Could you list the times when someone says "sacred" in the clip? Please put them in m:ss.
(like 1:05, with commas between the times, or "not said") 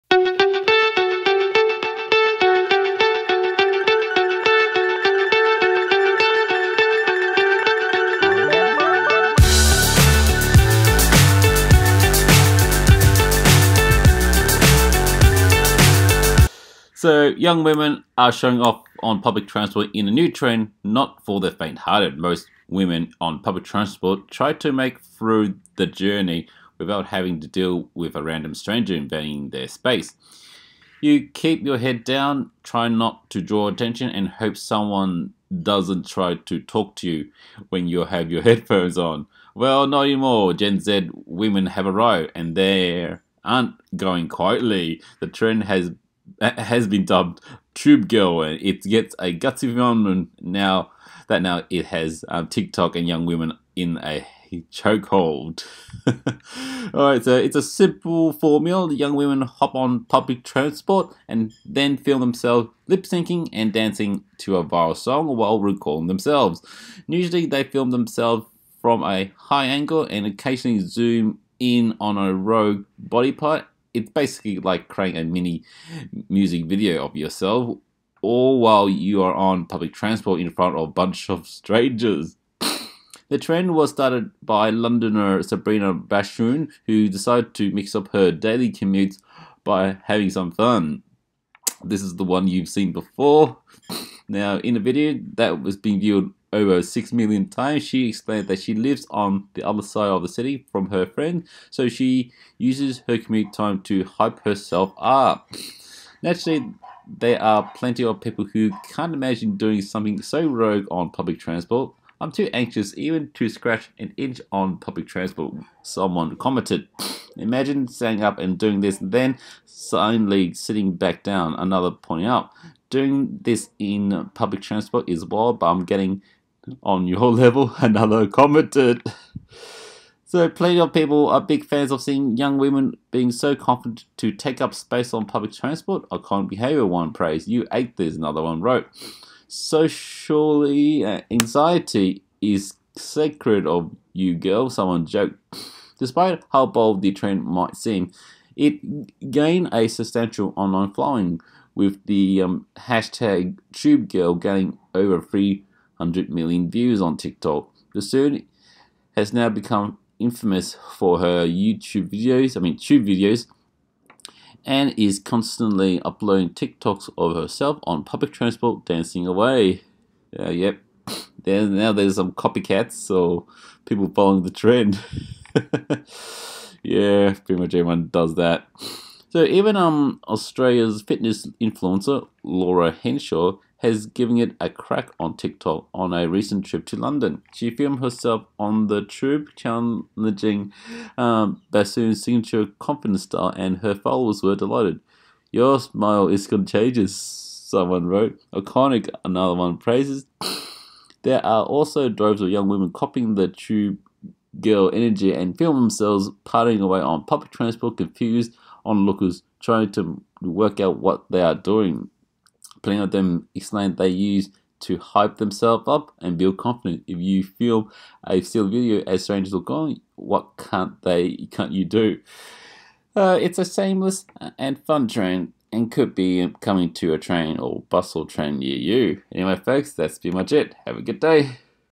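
2:22.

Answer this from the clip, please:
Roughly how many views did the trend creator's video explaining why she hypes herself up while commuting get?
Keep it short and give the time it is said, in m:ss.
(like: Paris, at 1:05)
Over 6 million, at 1:36.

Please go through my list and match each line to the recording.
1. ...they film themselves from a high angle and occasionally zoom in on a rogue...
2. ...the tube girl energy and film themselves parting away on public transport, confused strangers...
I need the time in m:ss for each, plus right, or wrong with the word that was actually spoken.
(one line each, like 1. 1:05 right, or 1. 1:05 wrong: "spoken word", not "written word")
1. 1:07 right
2. 3:23 wrong: "onlookers", not "strangers".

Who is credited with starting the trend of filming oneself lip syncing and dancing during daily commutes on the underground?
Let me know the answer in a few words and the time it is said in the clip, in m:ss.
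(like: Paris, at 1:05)
Sabrina Bahsoon, at 1:25.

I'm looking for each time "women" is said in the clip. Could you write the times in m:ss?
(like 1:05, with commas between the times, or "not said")
0:17, 0:22, 0:41, 0:53, 0:59, 2:12, 3:22.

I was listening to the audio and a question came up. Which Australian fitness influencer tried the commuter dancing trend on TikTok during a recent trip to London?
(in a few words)
Laura Henshaw.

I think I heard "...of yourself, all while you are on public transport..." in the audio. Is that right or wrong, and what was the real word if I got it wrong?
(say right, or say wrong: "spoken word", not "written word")
right.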